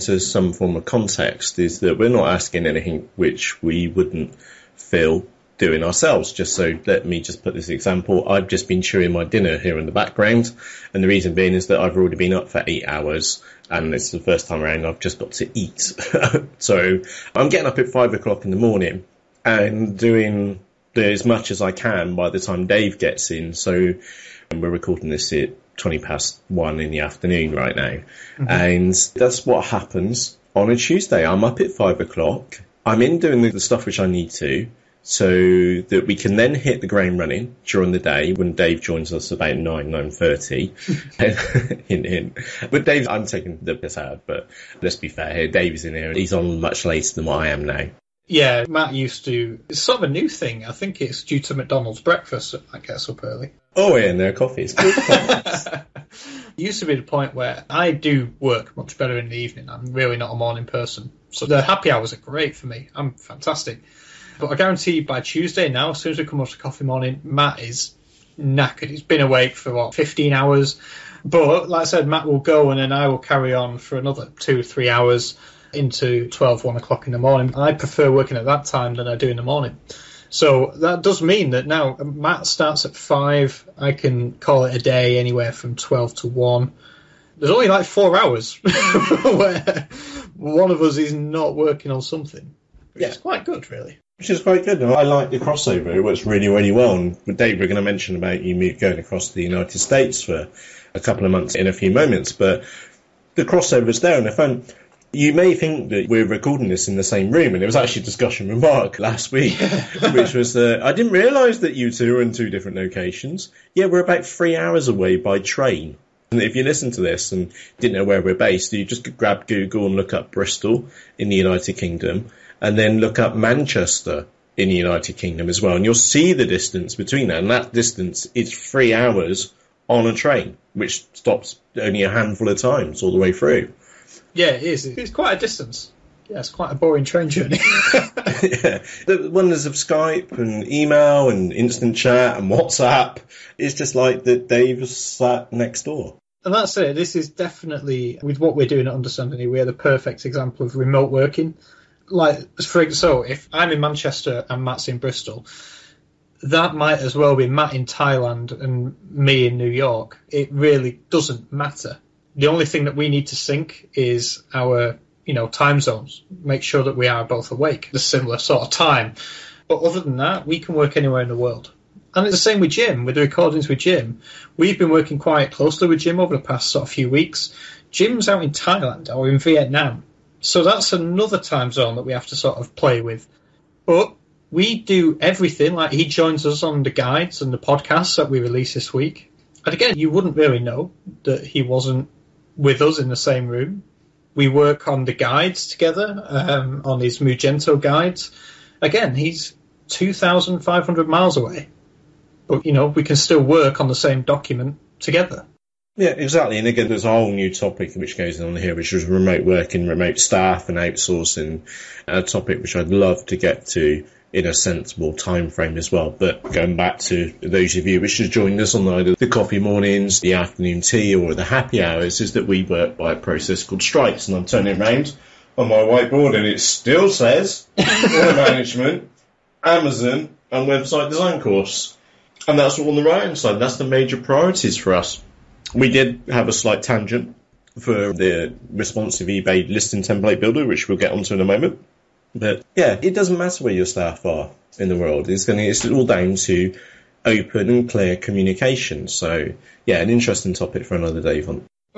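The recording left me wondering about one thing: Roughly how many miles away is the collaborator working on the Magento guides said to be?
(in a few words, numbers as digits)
2,500.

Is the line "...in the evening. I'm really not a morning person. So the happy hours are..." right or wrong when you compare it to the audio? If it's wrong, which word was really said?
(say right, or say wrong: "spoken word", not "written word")
right.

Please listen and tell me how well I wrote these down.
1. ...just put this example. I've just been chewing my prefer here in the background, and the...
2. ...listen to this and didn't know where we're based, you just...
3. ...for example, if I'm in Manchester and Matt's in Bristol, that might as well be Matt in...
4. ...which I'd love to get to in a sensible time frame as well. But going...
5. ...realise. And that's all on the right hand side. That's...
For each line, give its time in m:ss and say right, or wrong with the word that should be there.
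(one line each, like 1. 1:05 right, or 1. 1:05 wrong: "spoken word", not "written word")
1. 0:07 wrong: "dinner", not "prefer"
2. 1:56 right
3. 2:32 right
4. 3:32 right
5. 3:51 wrong: "course", not "realise".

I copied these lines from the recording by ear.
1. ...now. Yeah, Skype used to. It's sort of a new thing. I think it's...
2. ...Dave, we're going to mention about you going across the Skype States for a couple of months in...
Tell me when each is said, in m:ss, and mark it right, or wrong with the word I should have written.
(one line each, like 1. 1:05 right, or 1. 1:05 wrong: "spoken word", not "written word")
1. 0:47 wrong: "Matt", not "Skype"
2. 1:37 wrong: "United", not "Skype".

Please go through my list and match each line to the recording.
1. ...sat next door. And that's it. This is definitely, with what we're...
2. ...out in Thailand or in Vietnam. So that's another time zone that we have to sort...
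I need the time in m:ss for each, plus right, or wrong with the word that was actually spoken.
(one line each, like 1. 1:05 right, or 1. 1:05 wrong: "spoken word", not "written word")
1. 2:24 right
2. 2:58 right.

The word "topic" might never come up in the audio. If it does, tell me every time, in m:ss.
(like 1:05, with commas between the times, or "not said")
3:27, 3:32, 4:10.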